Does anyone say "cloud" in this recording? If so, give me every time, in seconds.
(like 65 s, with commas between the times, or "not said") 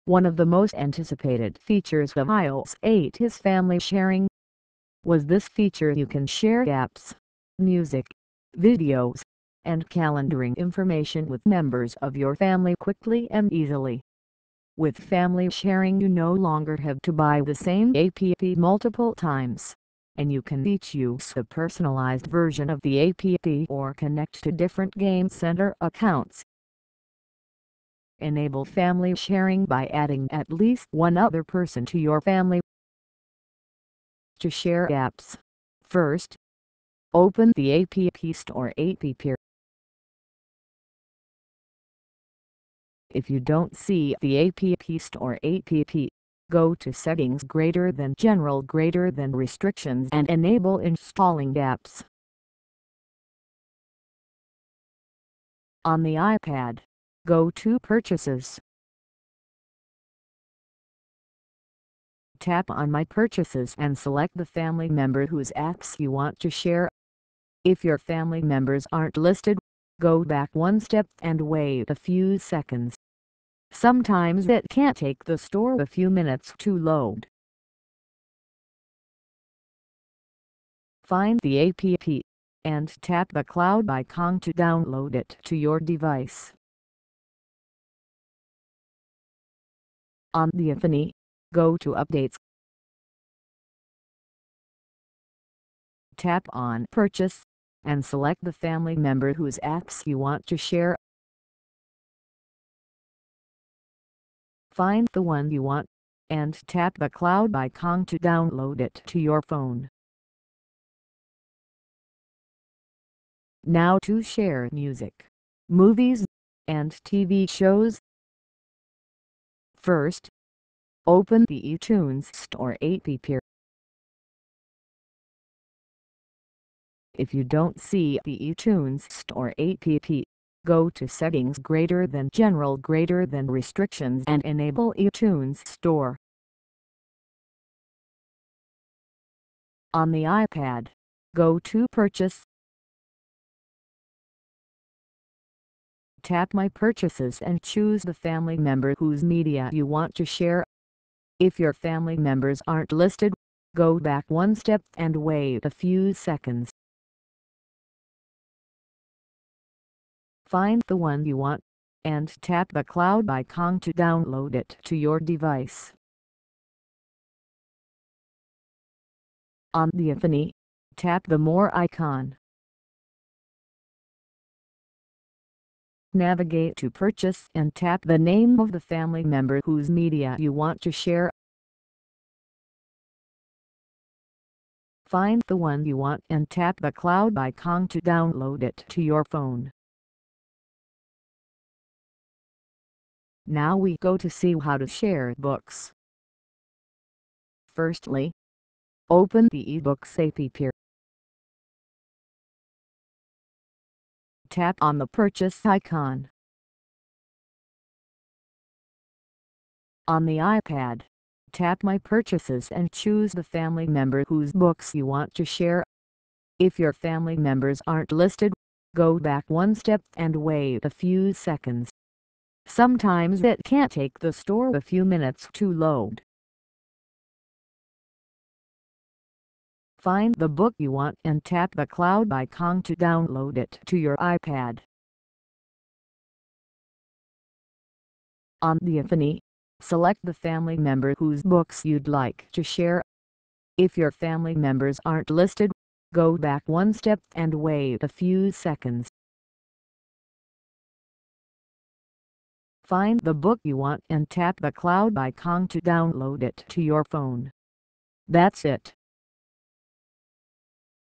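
83 s, 107 s, 162 s, 186 s, 231 s, 254 s.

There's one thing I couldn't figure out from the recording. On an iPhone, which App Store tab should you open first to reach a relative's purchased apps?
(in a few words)
Updates.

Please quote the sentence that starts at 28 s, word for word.
Enable family sharing by adding at least one other person to your family.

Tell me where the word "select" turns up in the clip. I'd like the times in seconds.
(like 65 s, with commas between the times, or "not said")
63 s, 98 s, 239 s.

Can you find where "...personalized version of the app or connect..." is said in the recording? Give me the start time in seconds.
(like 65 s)
21 s.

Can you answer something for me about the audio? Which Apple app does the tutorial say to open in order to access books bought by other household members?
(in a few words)
iBooks.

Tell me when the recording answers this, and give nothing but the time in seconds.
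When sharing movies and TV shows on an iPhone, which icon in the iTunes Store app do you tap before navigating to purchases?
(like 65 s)
171 s.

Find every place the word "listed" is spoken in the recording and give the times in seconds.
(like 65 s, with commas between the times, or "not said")
69 s, 152 s, 218 s, 245 s.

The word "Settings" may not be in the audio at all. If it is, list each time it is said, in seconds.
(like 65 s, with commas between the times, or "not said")
46 s, 131 s.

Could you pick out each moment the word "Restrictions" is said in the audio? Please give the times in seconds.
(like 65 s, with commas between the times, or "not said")
49 s, 133 s.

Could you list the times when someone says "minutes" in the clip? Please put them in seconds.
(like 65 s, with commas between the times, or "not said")
76 s, 225 s.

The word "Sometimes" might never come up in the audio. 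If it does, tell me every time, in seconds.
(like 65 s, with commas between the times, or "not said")
73 s, 222 s.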